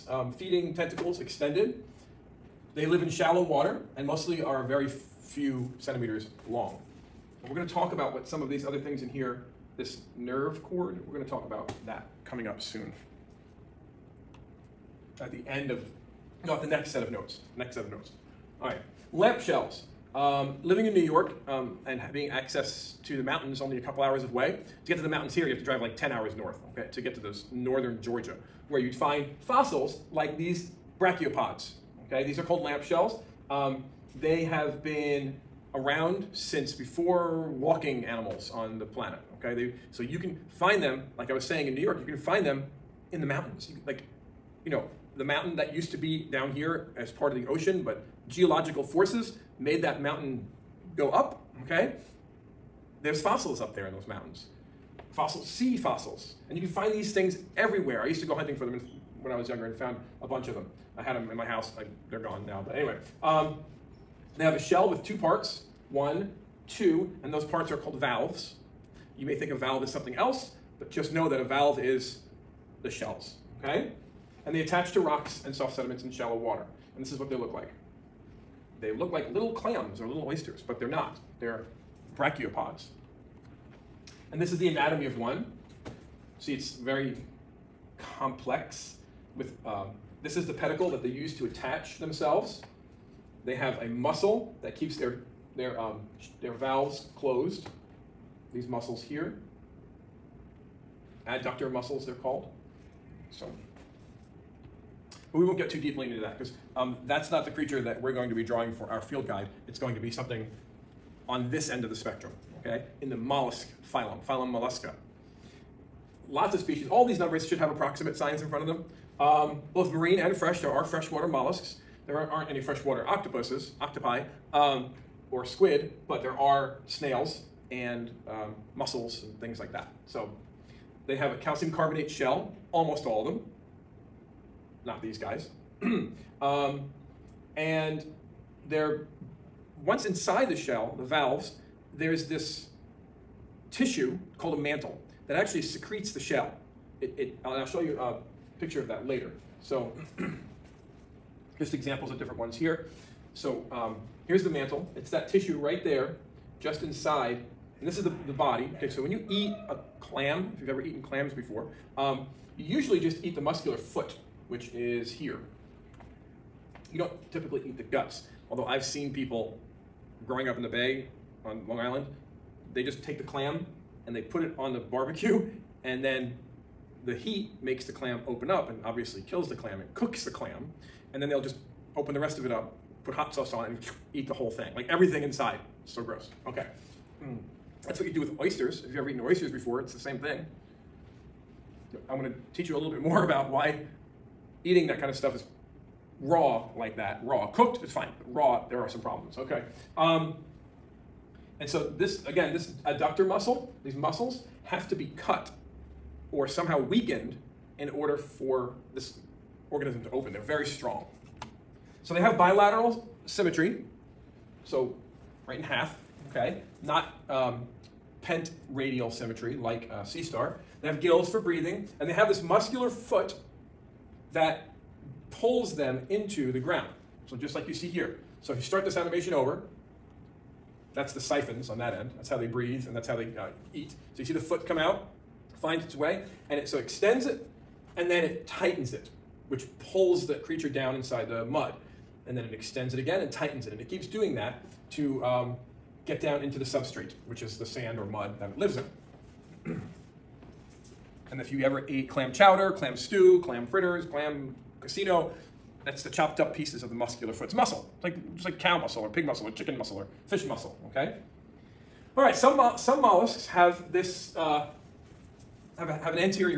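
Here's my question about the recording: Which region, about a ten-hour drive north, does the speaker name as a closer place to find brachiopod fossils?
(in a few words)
northern Georgia.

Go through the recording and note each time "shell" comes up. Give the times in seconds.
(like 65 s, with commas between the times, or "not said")
19 s, 32 s, 64 s, 72 s, 132 s, 140 s, 146 s.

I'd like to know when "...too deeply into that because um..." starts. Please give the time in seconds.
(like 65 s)
105 s.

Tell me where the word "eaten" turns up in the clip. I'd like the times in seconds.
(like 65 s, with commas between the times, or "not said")
160 s, 189 s.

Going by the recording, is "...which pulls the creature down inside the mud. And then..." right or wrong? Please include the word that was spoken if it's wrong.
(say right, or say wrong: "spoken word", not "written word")
right.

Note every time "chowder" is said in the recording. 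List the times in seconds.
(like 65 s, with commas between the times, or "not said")
252 s.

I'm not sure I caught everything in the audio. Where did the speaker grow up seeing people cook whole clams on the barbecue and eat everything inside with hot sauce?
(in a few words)
Long Island.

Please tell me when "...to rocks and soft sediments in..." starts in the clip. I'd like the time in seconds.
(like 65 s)
74 s.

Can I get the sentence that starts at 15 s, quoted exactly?
At the end of, not the next set of notes, next set of notes.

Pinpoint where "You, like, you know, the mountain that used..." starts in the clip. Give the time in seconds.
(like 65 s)
43 s.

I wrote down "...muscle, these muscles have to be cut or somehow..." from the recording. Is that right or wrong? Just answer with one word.
right.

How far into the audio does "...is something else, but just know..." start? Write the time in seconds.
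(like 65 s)
69 s.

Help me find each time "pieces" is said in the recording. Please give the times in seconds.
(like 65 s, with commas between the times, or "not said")
256 s.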